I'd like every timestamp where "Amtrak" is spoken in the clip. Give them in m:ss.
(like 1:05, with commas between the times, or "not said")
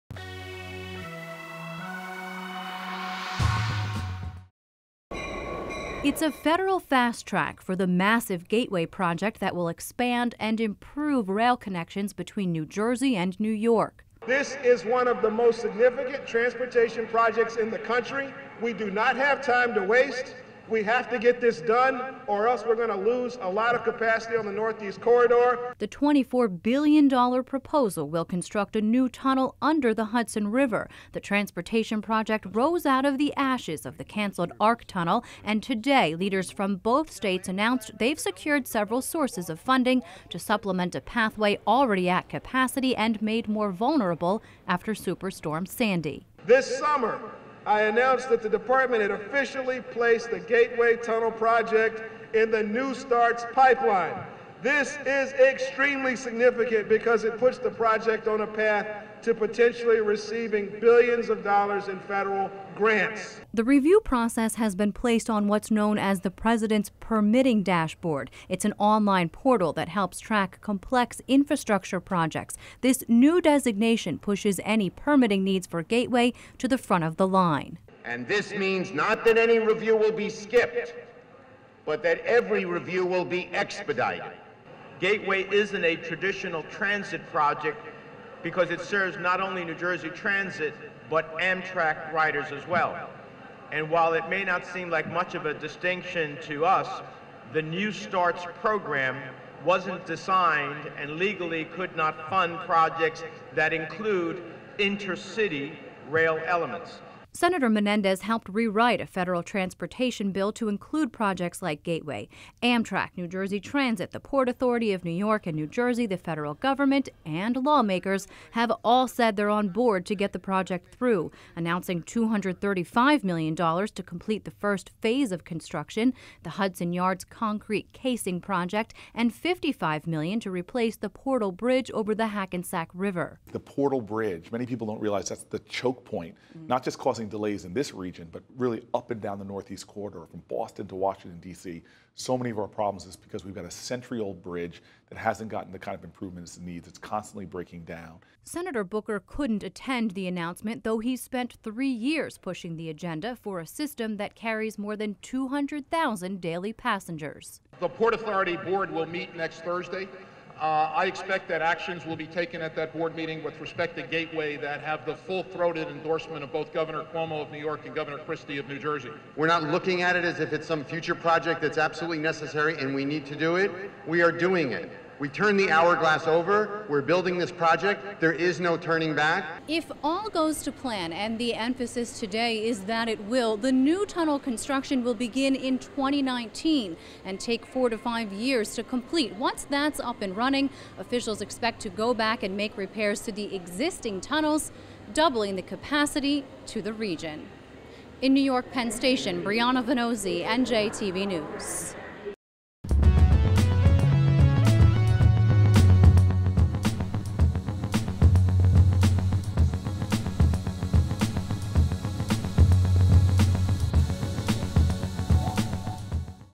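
1:31, 1:52.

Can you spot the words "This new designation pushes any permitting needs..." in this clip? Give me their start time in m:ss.
1:12.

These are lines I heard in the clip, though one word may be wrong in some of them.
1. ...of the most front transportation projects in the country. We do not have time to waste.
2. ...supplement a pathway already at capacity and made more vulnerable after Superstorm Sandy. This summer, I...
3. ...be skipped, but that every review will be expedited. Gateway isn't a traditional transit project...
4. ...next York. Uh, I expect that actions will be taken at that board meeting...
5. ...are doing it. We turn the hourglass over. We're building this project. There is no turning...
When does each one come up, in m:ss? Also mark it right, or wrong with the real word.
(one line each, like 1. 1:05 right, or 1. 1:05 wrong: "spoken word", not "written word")
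1. 0:15 wrong: "significant", not "front"
2. 0:40 right
3. 1:20 right
4. 2:39 wrong: "Thursday", not "York"
5. 2:54 right.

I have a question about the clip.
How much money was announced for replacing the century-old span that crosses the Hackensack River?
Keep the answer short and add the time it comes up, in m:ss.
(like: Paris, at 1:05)
$55 million, at 2:09.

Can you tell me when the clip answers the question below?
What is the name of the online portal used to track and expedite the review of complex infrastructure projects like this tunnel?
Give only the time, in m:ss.
1:06.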